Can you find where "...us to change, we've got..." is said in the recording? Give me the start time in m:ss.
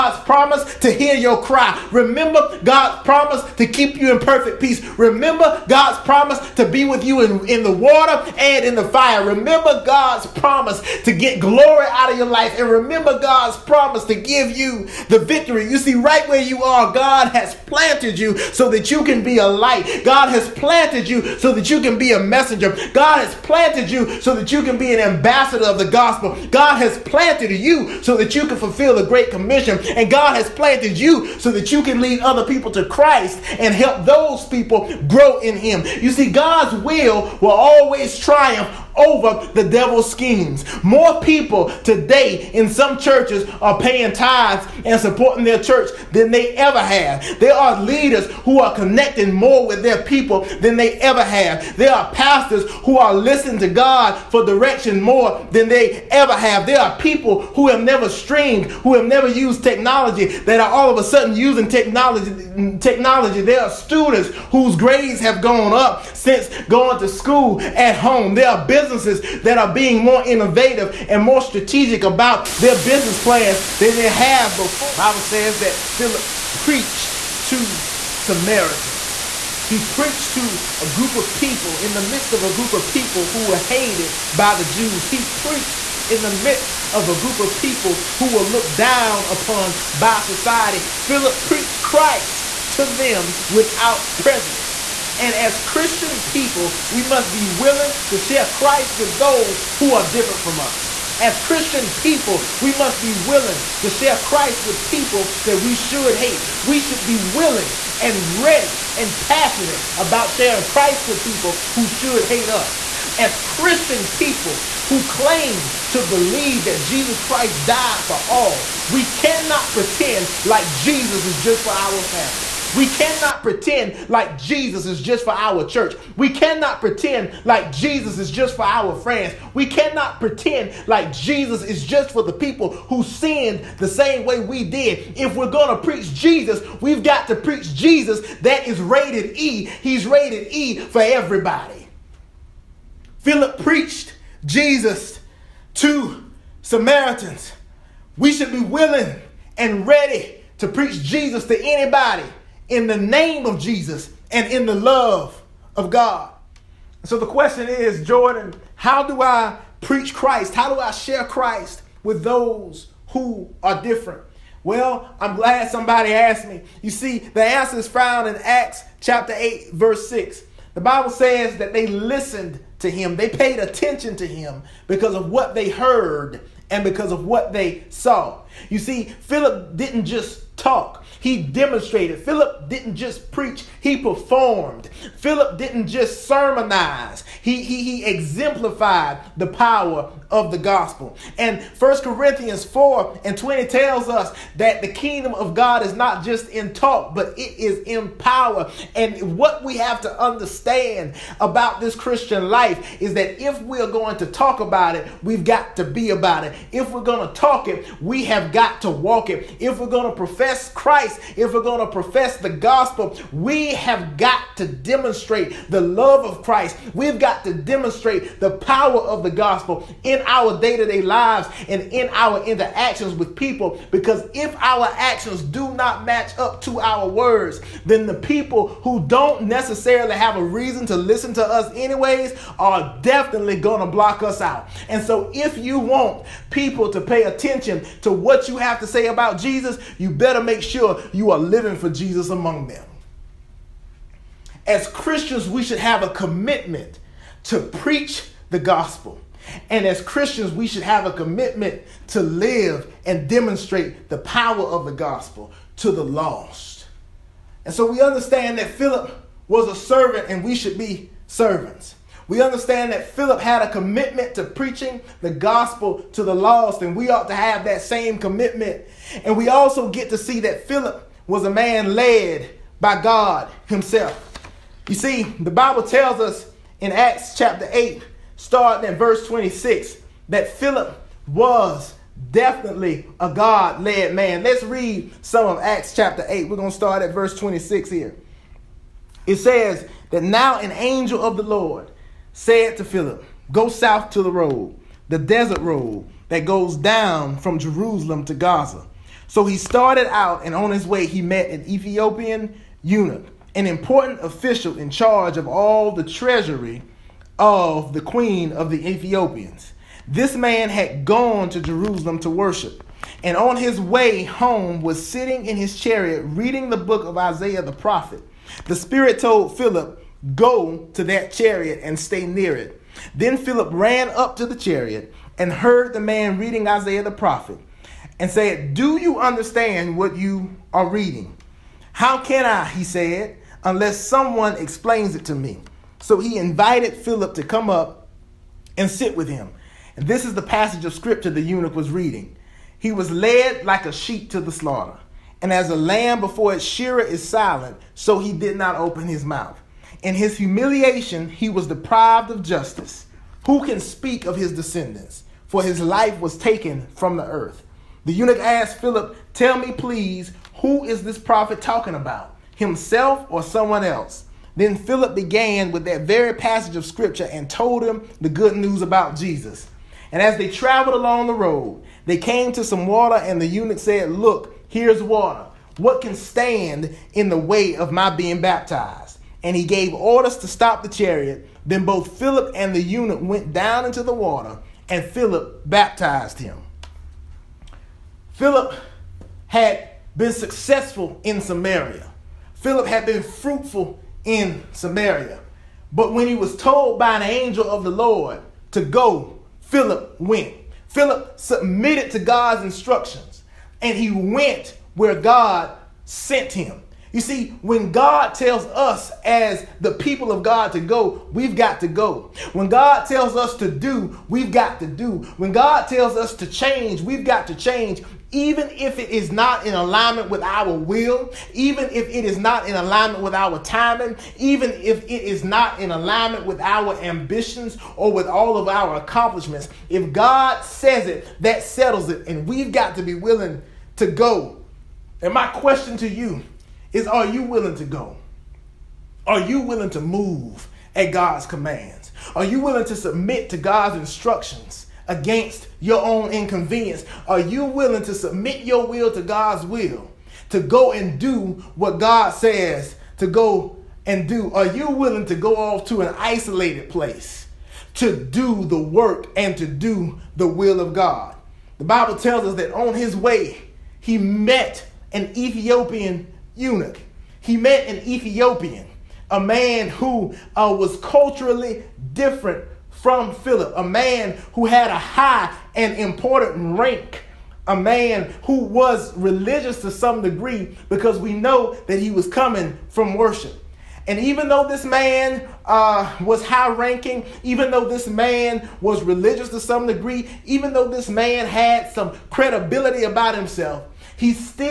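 6:56.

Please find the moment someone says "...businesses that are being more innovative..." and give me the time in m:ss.
1:08.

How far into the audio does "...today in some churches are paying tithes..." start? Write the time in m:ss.
0:41.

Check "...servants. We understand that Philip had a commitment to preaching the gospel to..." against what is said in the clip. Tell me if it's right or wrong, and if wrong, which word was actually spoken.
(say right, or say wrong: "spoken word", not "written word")
right.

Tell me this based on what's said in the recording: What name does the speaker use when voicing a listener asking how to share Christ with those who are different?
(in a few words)
Jordan.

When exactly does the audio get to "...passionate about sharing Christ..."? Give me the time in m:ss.
1:49.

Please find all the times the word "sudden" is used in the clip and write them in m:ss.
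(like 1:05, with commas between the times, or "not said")
1:01.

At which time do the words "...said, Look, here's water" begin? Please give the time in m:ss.
6:13.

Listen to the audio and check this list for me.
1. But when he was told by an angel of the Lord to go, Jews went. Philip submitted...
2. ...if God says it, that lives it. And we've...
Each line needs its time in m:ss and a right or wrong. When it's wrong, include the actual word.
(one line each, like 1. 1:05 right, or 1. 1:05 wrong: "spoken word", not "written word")
1. 6:35 wrong: "Philip", not "Jews"
2. 7:09 wrong: "settles", not "lives".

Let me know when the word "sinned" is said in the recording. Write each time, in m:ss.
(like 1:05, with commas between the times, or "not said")
2:13.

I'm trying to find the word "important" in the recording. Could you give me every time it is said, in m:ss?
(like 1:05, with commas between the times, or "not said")
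5:03, 7:55.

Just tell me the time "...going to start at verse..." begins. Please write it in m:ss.
4:46.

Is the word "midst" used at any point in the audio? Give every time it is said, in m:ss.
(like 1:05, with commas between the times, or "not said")
1:22, 1:26.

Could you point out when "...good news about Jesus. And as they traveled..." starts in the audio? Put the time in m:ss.
6:08.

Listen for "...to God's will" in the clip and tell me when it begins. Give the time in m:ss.
7:29.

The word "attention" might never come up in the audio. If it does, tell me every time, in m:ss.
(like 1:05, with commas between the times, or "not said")
2:53, 3:57.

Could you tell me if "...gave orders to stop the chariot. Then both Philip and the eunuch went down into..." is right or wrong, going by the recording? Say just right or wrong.
right.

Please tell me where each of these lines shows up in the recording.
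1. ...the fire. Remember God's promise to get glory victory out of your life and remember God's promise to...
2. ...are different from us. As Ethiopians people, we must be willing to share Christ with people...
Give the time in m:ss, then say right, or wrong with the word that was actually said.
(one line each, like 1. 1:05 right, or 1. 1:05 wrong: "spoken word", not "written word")
1. 0:08 wrong: "glory", not "victory"
2. 1:39 wrong: "Christian", not "Ethiopians".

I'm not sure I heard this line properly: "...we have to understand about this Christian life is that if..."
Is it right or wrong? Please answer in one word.
right.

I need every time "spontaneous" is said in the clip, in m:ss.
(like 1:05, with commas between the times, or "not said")
not said.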